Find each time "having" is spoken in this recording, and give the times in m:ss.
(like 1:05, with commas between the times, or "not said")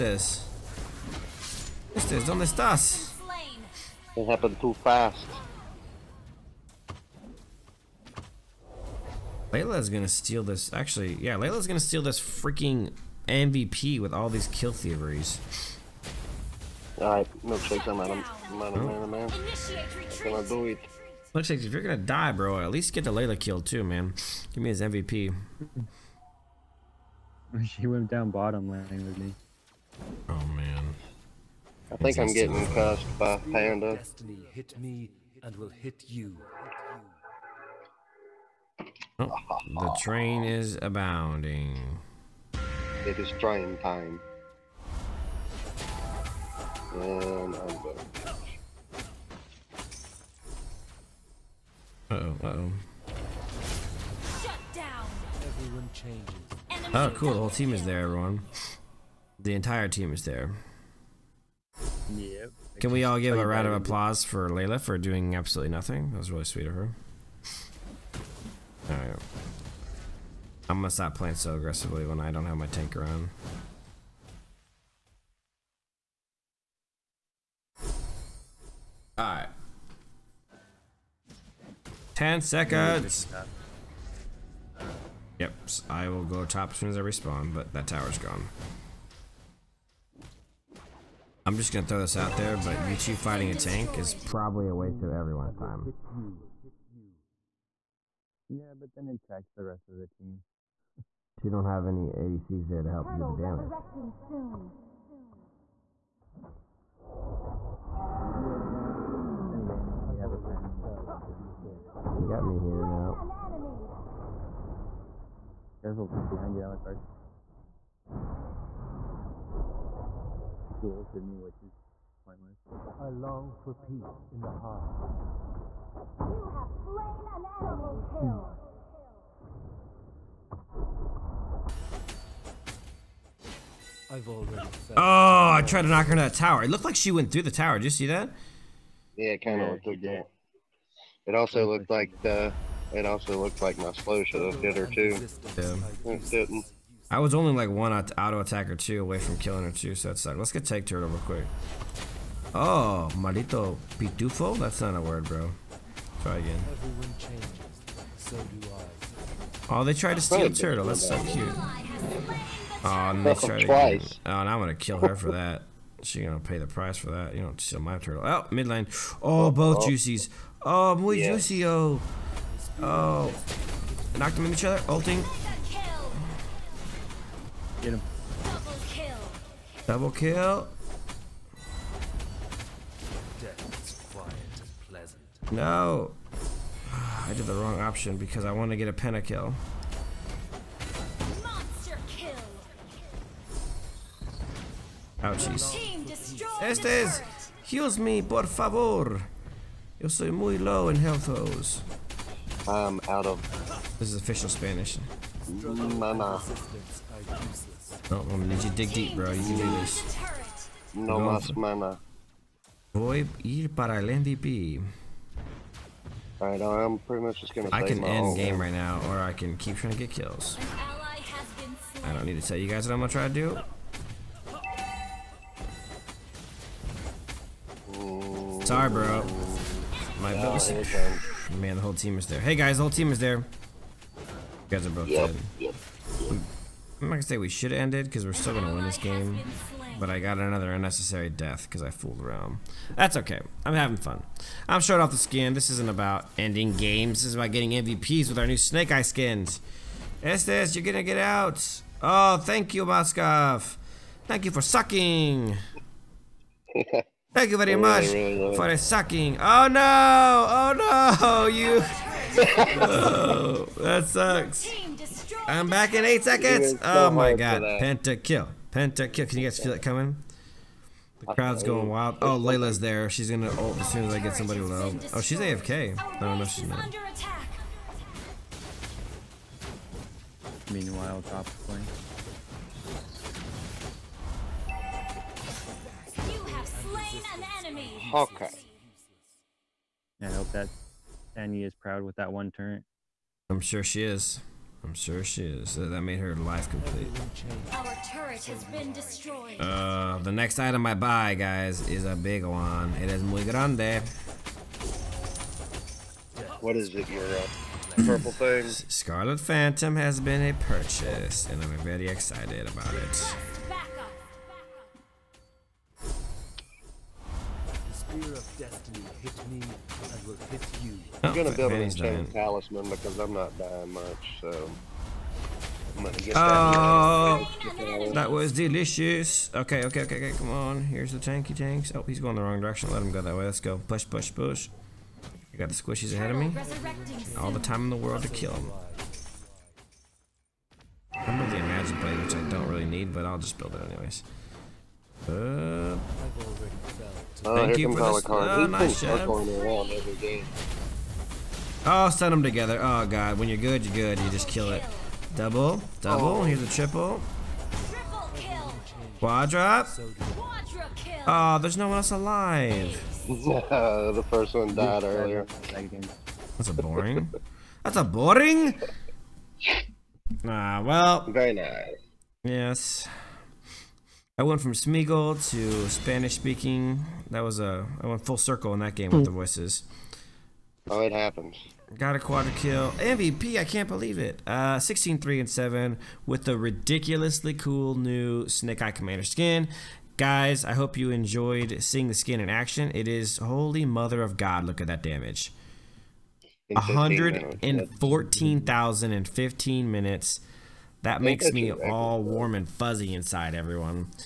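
4:03.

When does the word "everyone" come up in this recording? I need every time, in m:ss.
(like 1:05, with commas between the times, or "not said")
0:58, 1:35, 6:43.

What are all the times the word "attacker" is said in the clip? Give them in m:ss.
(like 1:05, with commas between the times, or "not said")
2:28.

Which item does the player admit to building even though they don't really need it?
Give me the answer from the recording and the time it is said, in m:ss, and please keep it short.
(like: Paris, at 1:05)
imagine blade, at 5:41.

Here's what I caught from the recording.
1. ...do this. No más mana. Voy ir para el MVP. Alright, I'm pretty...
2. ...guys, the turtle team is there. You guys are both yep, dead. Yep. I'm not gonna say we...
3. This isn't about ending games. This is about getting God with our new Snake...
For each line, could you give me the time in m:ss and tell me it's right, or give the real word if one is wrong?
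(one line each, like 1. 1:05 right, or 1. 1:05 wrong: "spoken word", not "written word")
1. 3:29 right
2. 3:52 wrong: "whole", not "turtle"
3. 4:05 wrong: "MVPs", not "God".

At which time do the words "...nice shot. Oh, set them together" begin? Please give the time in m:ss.
5:48.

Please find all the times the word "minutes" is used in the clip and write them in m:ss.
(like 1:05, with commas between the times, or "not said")
6:39.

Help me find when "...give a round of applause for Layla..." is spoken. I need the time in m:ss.
1:03.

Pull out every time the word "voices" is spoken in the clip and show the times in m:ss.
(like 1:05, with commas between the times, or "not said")
6:19.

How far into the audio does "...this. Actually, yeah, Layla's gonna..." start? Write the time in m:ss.
0:10.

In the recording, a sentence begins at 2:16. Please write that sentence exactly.
It looked like she went through the tower.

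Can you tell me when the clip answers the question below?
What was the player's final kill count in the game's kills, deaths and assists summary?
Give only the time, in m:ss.
6:24.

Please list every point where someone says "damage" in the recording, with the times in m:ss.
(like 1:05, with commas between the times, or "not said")
1:43, 6:35.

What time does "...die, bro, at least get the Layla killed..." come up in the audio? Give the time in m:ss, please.
0:21.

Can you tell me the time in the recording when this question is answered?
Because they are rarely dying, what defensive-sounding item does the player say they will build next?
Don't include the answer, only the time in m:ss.
5:21.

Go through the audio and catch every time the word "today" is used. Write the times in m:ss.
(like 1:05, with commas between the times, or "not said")
not said.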